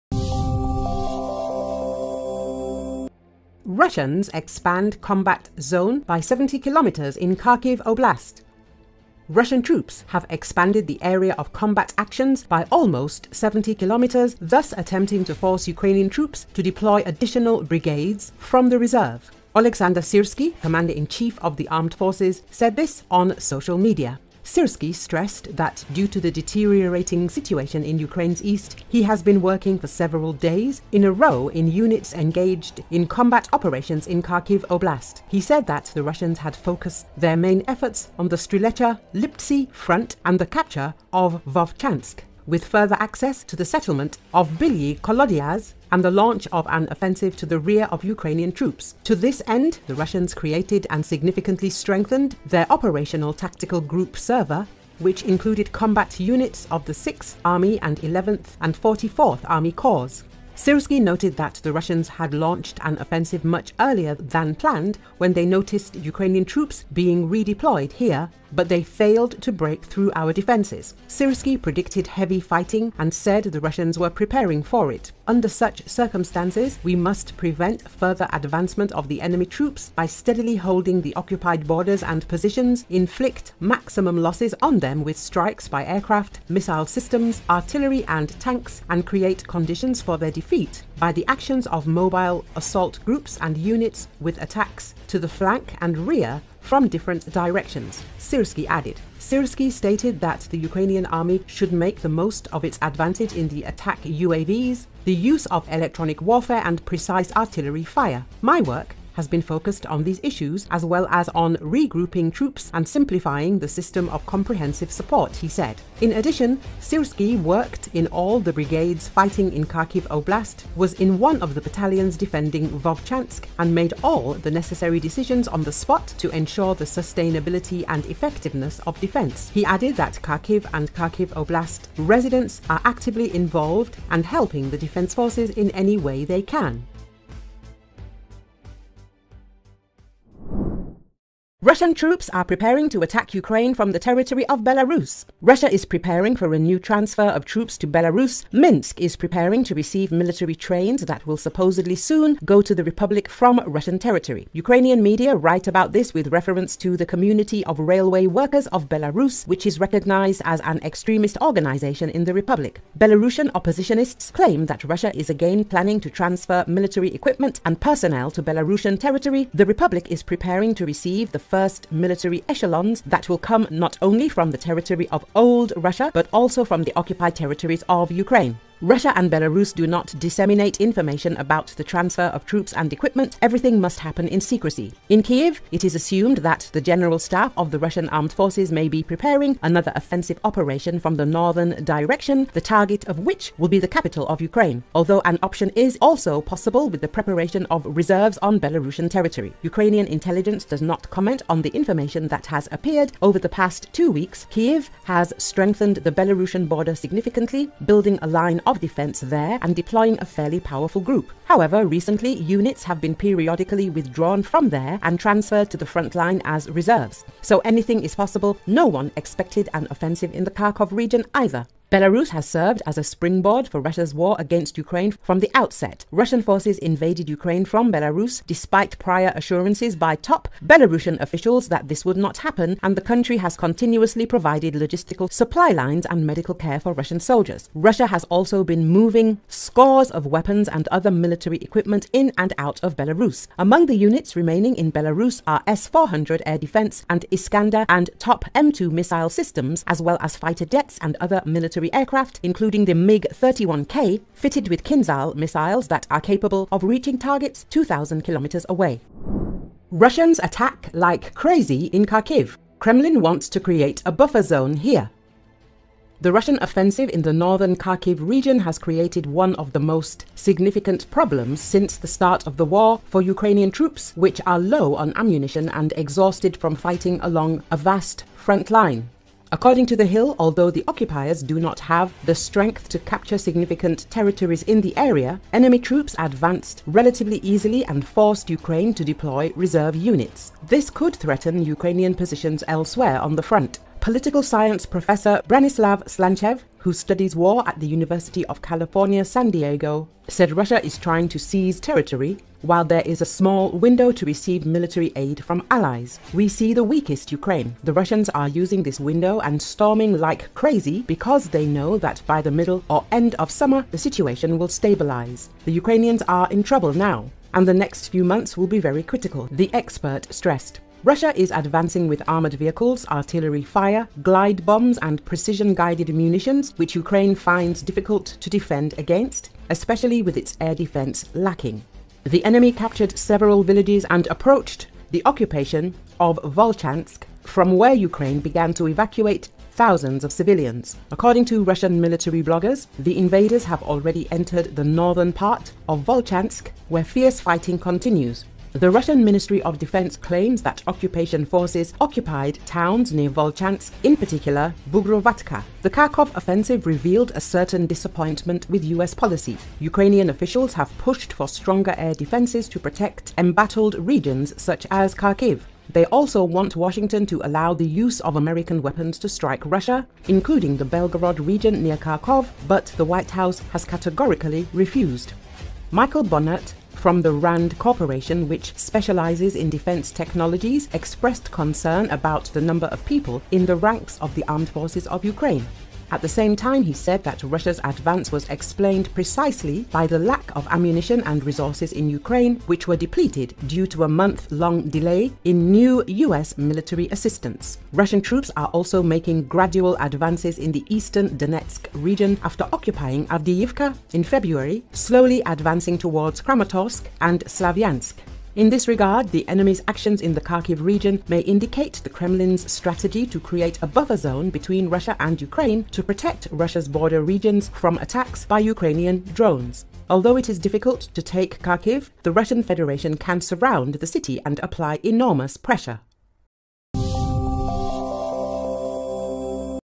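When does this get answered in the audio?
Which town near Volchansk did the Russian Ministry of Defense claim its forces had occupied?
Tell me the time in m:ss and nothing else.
5:54.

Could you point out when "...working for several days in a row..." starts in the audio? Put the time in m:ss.
0:29.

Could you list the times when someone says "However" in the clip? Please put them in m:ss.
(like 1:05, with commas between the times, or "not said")
3:31.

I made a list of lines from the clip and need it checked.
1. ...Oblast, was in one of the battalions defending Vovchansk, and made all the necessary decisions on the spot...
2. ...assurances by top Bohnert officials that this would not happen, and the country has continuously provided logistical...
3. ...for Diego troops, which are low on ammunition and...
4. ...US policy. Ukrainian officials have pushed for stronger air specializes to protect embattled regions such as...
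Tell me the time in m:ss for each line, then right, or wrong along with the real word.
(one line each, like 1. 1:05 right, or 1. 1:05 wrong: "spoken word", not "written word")
1. 2:00 right
2. 3:49 wrong: "Belarusian", not "Bohnert"
3. 4:33 wrong: "Ukrainian", not "Diego"
4. 5:58 wrong: "defenses", not "specializes".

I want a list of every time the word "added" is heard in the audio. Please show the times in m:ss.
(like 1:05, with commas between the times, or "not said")
1:38, 2:09.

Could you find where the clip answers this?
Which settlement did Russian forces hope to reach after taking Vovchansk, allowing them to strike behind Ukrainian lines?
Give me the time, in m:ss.
0:44.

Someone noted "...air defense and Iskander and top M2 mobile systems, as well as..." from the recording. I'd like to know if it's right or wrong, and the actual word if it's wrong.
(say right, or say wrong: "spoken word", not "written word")
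wrong: "missile", not "mobile".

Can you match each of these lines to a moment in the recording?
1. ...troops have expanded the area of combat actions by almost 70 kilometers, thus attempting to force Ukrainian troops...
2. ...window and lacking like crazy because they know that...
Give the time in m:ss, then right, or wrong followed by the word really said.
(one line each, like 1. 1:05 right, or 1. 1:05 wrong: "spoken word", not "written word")
1. 0:09 right
2. 5:08 wrong: "storming", not "lacking".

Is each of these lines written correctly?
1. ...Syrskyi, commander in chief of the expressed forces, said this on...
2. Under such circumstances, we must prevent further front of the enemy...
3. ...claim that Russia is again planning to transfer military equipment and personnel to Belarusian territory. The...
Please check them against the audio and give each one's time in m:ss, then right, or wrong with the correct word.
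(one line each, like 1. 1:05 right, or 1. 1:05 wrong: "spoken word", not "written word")
1. 0:20 wrong: "armed", not "expressed"
2. 1:15 wrong: "advancement", not "front"
3. 2:44 right.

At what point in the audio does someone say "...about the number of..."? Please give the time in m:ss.
6:22.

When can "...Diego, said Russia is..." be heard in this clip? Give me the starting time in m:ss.
4:59.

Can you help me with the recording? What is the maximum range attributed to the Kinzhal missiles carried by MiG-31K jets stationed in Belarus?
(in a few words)
2,000 kilometers.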